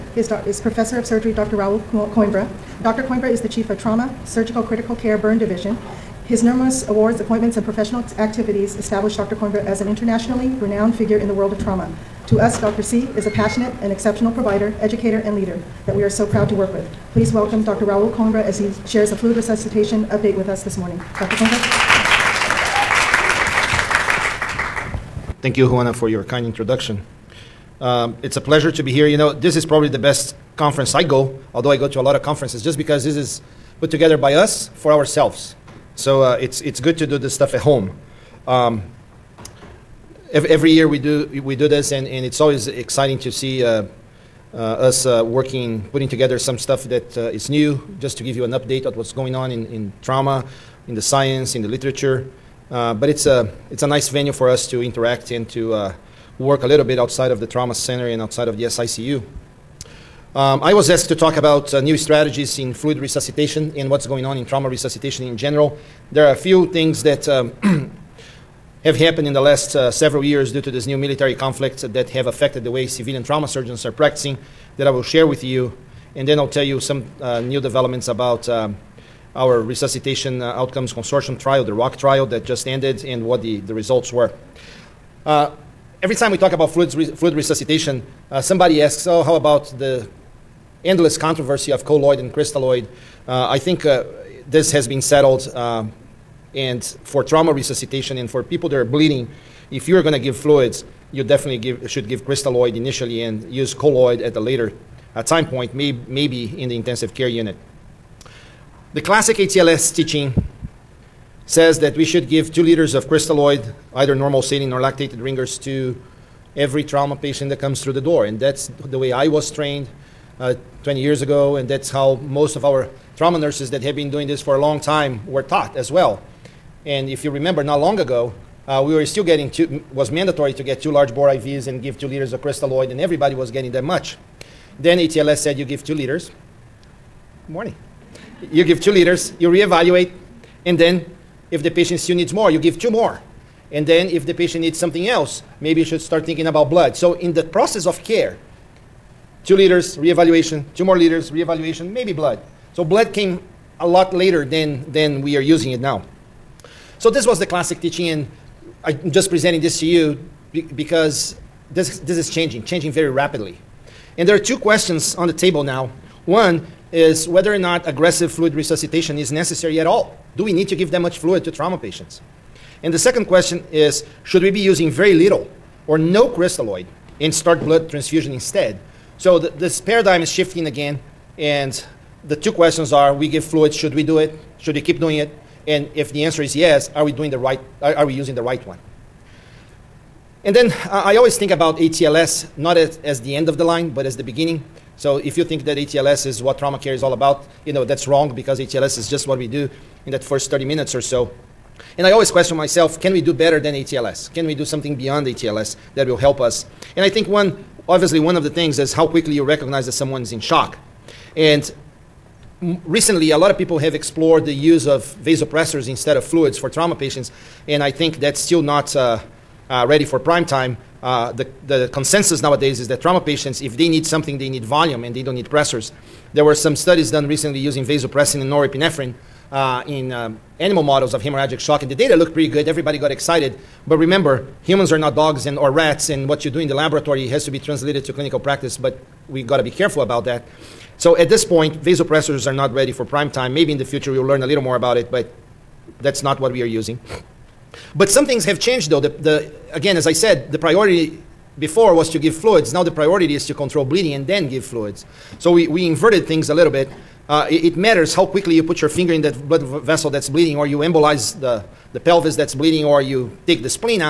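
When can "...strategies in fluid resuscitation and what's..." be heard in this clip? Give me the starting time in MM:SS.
01:01.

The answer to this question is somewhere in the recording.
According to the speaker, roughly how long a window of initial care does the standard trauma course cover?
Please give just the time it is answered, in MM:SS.
03:20.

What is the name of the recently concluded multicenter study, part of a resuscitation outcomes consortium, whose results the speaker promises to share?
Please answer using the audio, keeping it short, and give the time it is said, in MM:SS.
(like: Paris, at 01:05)
ROC trial, at 01:21.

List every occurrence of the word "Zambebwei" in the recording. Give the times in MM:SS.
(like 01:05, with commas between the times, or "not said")
not said.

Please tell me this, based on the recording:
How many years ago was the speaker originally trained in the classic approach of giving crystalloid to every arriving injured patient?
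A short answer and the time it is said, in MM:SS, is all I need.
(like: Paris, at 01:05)
20, at 02:00.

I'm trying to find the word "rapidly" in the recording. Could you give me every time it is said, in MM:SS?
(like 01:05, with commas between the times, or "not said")
02:43.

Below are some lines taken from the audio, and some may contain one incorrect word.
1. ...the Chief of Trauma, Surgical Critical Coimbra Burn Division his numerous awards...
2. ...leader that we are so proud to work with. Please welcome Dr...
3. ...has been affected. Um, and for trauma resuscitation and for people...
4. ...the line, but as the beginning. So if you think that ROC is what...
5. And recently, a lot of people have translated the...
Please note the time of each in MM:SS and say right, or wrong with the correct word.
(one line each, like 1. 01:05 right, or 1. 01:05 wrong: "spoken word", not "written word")
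1. 00:03 wrong: "Care", not "Coimbra"
2. 00:15 right
3. 01:34 wrong: "settled", not "affected"
4. 03:13 wrong: "ATLS", not "ROC"
5. 03:31 wrong: "explored", not "translated".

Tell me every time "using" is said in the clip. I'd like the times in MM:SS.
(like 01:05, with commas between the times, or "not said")
02:35, 02:54, 03:08, 03:47, 04:06.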